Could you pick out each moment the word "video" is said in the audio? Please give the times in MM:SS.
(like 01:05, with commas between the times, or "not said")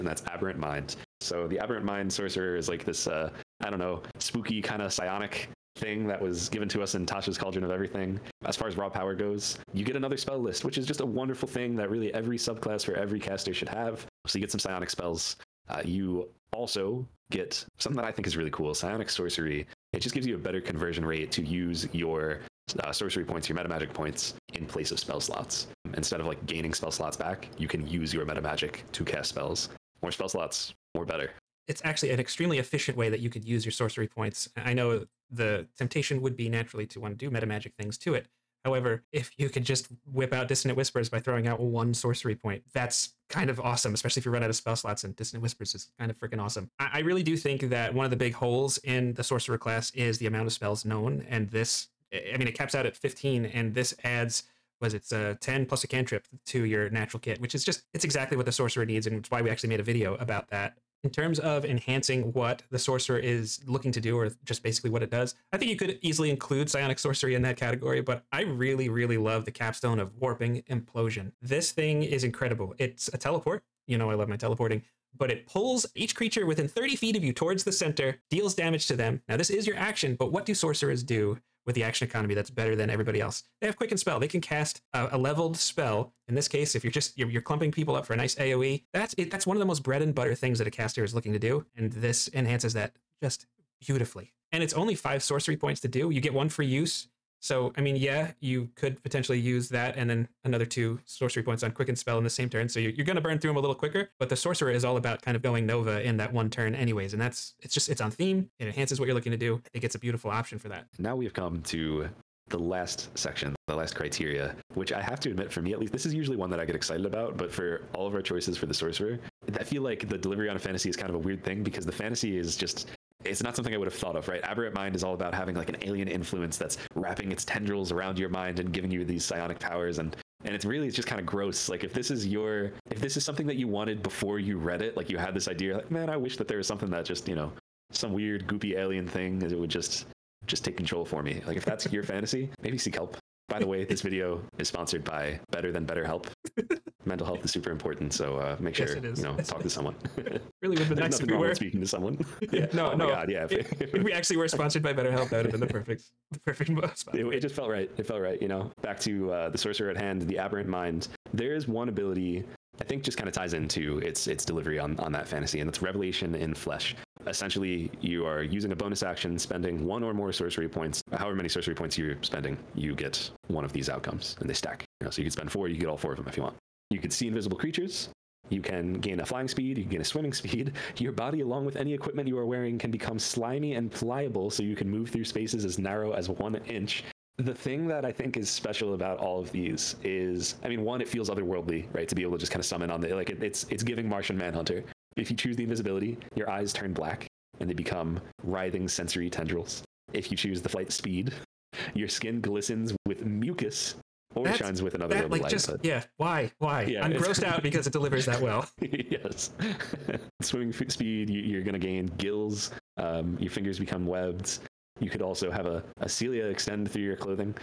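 00:59, 02:23.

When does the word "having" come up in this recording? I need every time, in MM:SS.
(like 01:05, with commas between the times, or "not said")
02:05.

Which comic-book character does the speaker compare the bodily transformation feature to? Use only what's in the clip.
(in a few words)
Martian Manhunter.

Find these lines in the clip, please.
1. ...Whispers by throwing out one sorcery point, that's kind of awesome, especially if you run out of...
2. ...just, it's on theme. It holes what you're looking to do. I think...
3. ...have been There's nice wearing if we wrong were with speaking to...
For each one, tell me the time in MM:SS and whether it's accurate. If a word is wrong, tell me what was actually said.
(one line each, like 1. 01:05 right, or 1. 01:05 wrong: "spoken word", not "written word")
1. 00:40 right
2. 01:47 wrong: "enhances", not "holes"
3. 02:30 wrong: "nothing", not "wearing".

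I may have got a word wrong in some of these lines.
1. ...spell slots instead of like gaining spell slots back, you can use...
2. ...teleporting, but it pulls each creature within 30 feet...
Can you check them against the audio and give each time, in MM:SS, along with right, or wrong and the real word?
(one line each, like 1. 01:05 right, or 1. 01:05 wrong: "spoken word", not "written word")
1. 00:24 right
2. 01:14 right.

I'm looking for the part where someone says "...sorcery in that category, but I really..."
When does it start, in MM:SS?
01:06.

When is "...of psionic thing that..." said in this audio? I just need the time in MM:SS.
00:04.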